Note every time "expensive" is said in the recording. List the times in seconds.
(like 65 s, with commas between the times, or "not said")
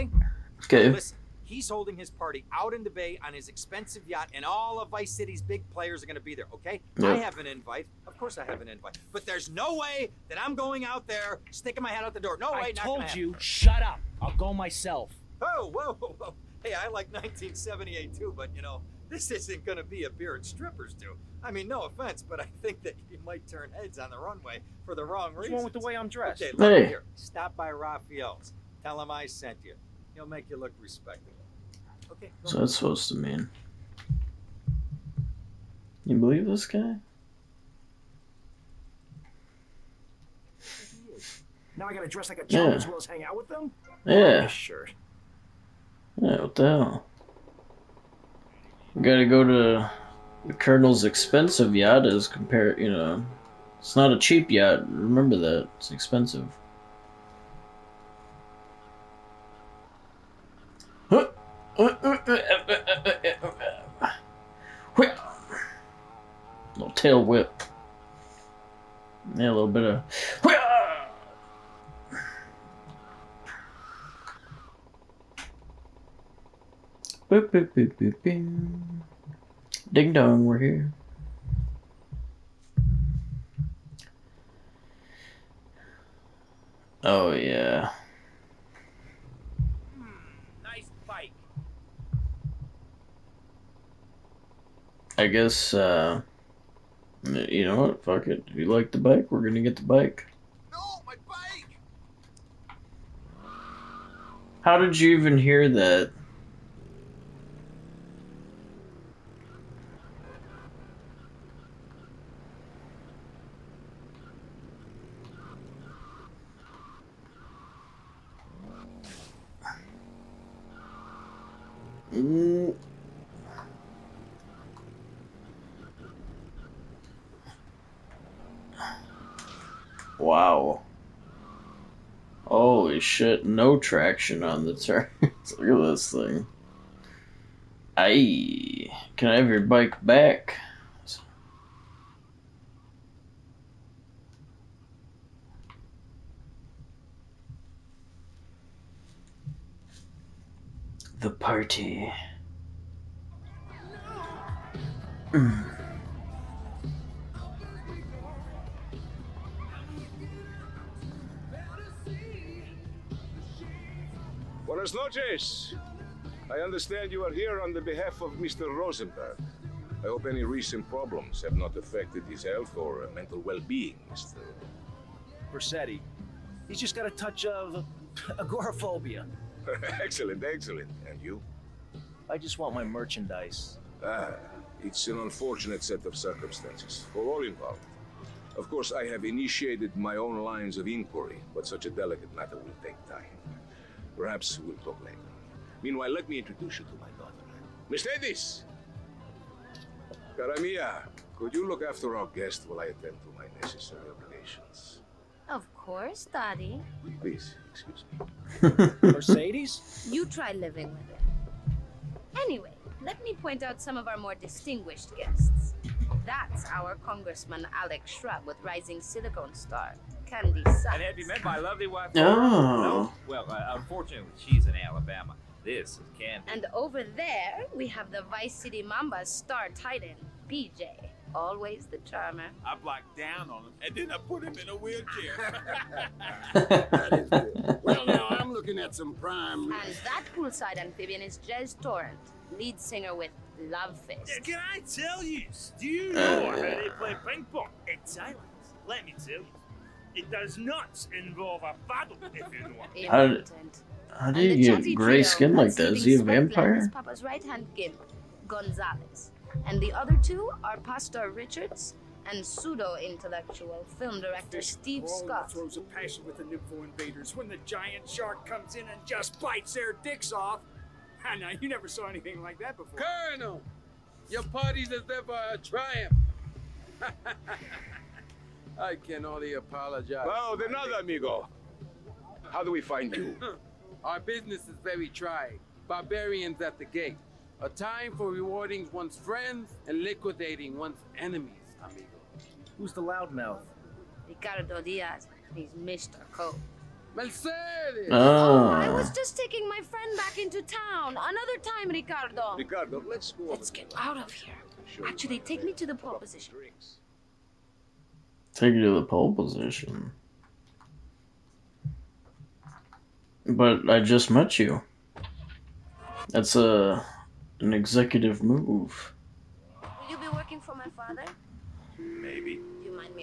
3 s, 51 s, 55 s.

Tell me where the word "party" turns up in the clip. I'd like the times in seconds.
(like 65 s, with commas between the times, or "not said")
2 s, 151 s, 274 s.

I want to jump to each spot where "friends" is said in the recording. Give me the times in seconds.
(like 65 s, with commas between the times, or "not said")
289 s, 299 s.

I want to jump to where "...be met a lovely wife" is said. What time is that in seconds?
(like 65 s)
221 s.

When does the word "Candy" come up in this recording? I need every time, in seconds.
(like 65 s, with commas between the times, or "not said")
220 s, 226 s.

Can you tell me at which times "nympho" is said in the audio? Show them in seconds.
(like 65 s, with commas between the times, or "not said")
266 s.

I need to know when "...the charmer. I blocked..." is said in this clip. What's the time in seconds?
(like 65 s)
231 s.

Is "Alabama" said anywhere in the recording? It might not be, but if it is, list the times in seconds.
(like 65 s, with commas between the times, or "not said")
224 s.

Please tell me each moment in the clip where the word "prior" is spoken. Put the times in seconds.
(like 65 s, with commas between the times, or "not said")
not said.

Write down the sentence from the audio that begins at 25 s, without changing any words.
What's with the way I'm dressed?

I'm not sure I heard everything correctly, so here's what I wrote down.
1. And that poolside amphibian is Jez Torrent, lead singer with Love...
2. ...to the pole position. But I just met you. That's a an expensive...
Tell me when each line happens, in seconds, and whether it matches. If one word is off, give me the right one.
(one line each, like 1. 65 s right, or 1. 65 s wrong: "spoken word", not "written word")
1. 239 s right
2. 308 s wrong: "executive", not "expensive".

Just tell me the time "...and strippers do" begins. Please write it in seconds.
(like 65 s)
20 s.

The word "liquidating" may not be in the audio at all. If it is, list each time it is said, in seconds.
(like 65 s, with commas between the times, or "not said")
290 s.